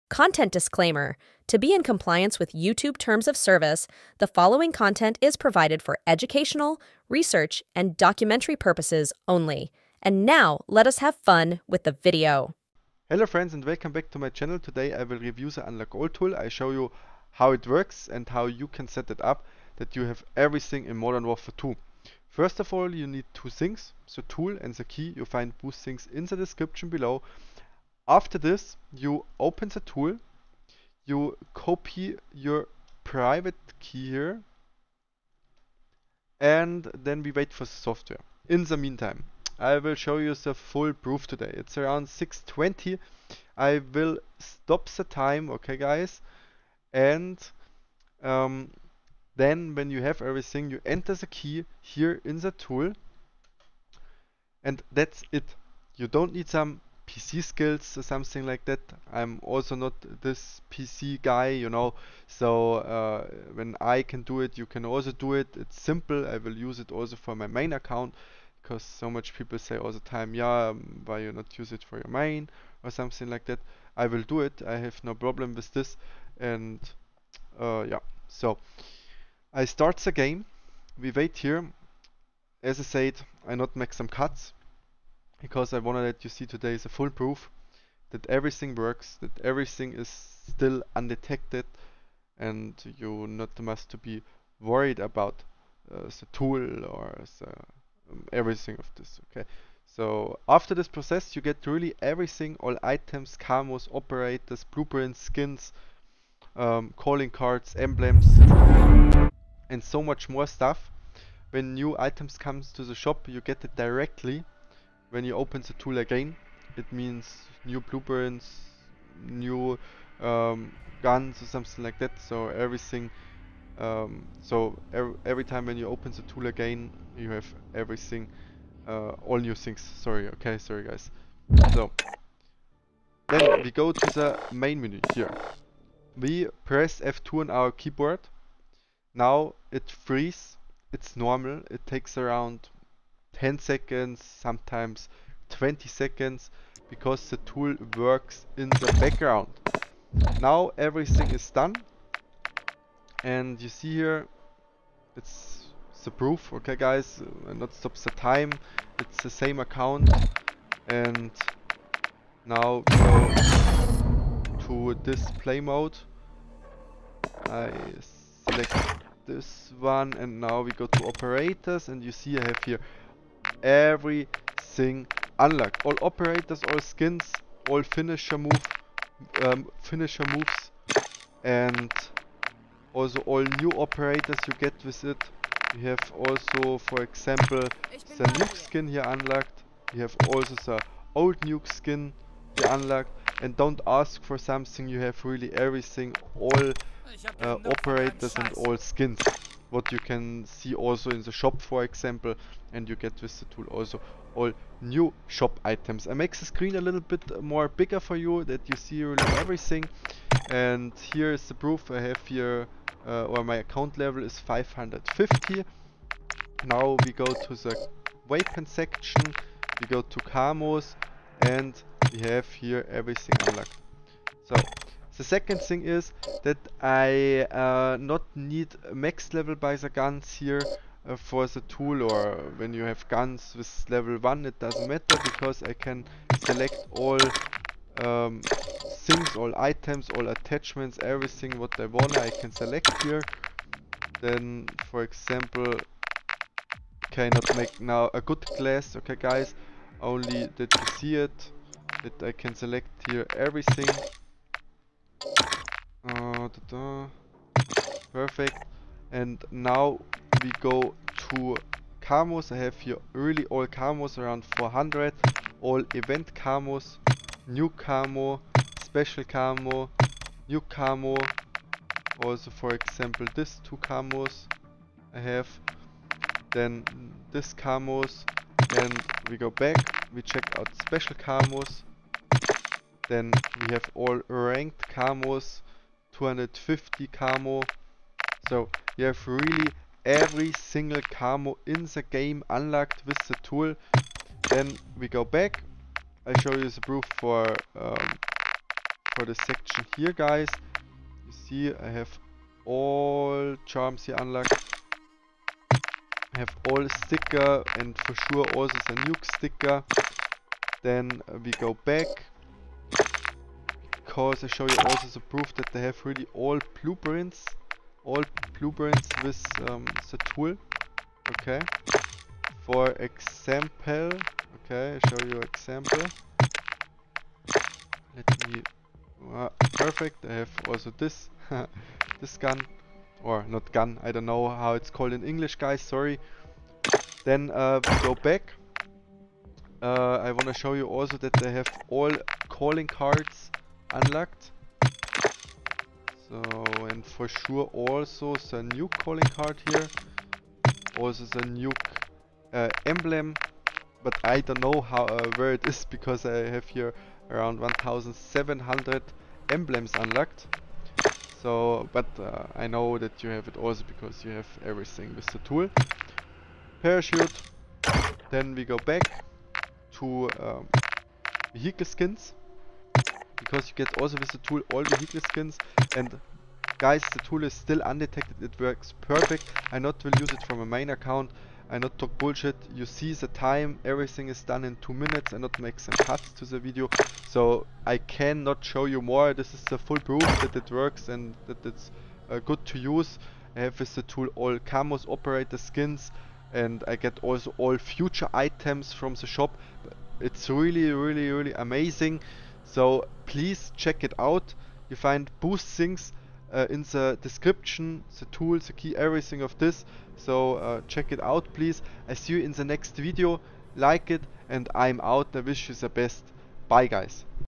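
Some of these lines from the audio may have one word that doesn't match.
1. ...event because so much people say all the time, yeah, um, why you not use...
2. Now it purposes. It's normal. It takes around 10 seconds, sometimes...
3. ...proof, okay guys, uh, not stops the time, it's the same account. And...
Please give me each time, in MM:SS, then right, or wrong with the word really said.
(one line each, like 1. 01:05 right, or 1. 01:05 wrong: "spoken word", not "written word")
1. 01:07 wrong: "account", not "event"
2. 02:19 wrong: "freezes", not "purposes"
3. 02:36 right.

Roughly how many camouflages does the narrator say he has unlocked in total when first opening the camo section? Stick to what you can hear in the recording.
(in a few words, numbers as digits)
400.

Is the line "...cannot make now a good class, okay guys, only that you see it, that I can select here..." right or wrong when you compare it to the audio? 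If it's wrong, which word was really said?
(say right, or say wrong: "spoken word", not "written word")
right.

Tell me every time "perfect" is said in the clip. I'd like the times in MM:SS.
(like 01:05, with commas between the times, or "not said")
04:18, 05:29, 06:19.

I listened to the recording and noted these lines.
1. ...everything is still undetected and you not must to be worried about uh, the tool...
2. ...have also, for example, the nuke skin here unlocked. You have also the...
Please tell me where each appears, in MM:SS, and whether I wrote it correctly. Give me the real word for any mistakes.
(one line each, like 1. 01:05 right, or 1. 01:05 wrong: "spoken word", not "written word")
1. 01:29 right
2. 03:05 right.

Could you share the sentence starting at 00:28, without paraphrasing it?
After this, you open the tool, you copy your private key here, and then we wait for the software.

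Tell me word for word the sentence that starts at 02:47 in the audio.
I select this one and now we go to operators and you see I have here everything unlocked.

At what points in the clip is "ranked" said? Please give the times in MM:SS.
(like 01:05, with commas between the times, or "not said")
04:44.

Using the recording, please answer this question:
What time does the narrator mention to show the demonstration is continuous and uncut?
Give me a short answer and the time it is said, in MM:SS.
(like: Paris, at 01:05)
6.20, at 00:42.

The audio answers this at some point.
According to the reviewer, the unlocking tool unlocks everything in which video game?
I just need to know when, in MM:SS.
00:20.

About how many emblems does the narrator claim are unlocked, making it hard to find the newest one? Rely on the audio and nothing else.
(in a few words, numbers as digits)
1700.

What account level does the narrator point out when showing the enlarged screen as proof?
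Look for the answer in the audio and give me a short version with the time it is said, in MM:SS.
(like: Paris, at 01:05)
550, at 03:34.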